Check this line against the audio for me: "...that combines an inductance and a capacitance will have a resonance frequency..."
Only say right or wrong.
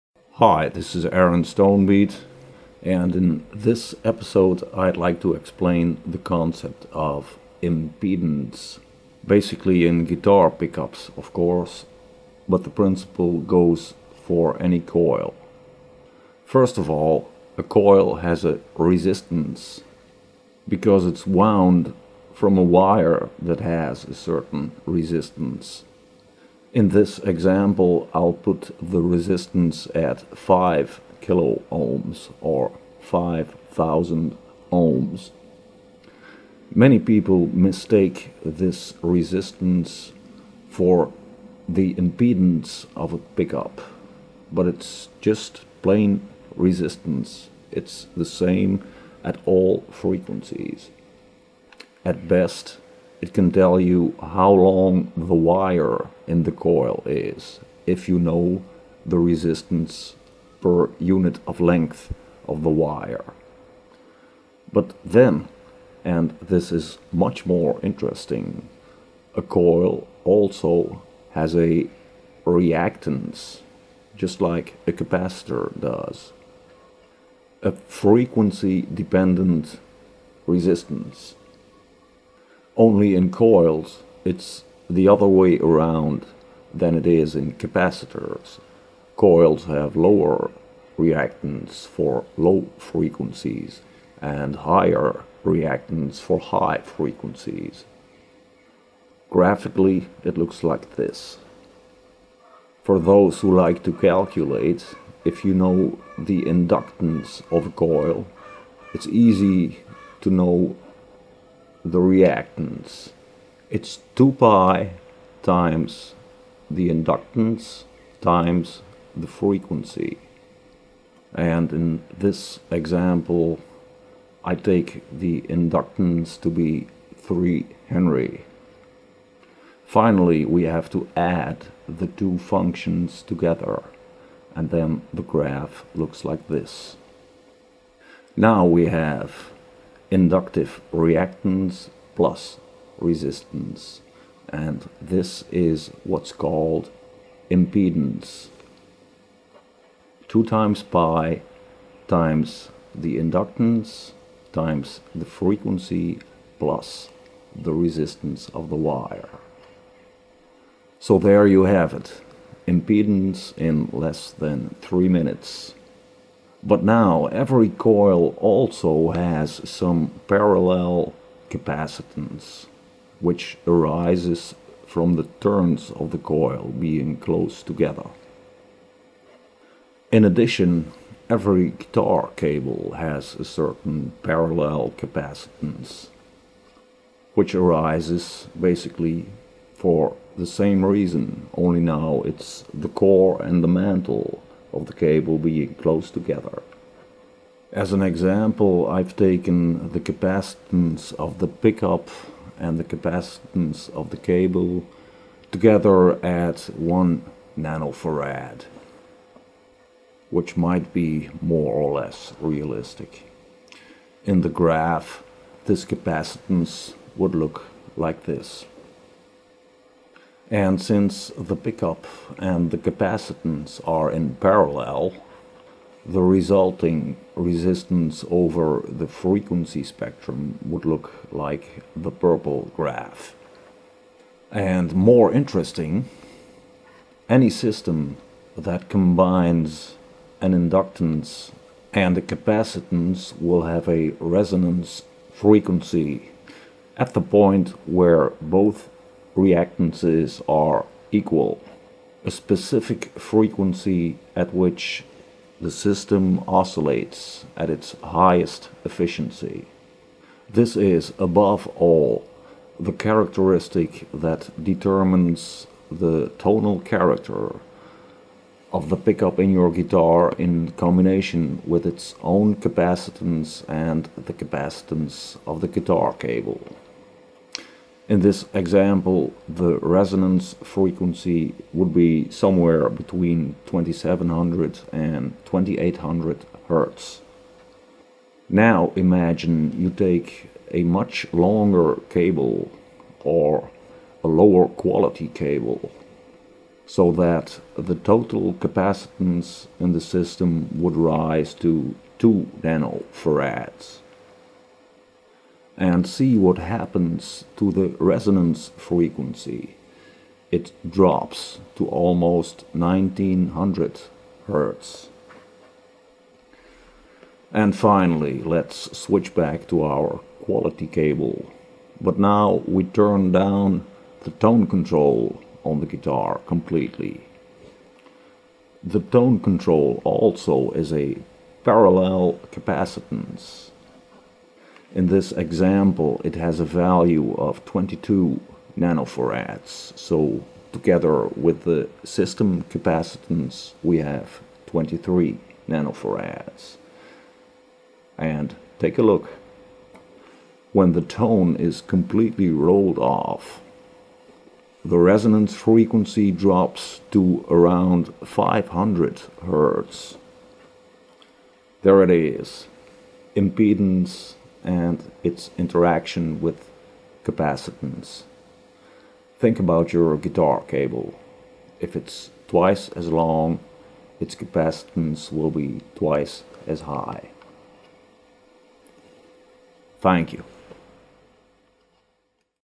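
right.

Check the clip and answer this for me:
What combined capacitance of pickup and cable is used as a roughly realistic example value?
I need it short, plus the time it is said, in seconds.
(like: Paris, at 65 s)
1 nanofarad, at 206 s.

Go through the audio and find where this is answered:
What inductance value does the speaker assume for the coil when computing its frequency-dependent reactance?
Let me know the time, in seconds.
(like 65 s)
127 s.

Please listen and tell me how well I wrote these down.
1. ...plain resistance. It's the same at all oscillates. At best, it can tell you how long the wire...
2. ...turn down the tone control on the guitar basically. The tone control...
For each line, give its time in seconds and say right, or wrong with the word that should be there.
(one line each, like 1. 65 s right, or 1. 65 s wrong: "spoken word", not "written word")
1. 45 s wrong: "frequencies", not "oscillates"
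2. 322 s wrong: "completely", not "basically".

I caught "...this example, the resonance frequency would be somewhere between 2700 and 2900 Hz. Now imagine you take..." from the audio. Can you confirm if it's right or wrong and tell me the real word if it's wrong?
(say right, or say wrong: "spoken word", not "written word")
wrong: "2800", not "2900".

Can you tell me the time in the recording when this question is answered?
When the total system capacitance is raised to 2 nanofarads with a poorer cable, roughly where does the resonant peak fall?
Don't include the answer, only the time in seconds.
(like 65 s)
312 s.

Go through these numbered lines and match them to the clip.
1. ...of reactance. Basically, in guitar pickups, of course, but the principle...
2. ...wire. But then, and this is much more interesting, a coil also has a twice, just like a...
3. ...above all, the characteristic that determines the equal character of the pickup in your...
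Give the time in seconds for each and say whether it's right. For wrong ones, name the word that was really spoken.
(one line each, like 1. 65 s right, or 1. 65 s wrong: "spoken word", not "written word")
1. 6 s wrong: "impedance", not "reactance"
2. 62 s wrong: "reactance", not "twice"
3. 261 s wrong: "tonal", not "equal".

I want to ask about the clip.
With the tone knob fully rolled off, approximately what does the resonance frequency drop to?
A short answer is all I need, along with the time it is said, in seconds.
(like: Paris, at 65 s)
500 Hz, at 358 s.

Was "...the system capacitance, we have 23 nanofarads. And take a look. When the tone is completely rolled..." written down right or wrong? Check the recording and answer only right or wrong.
right.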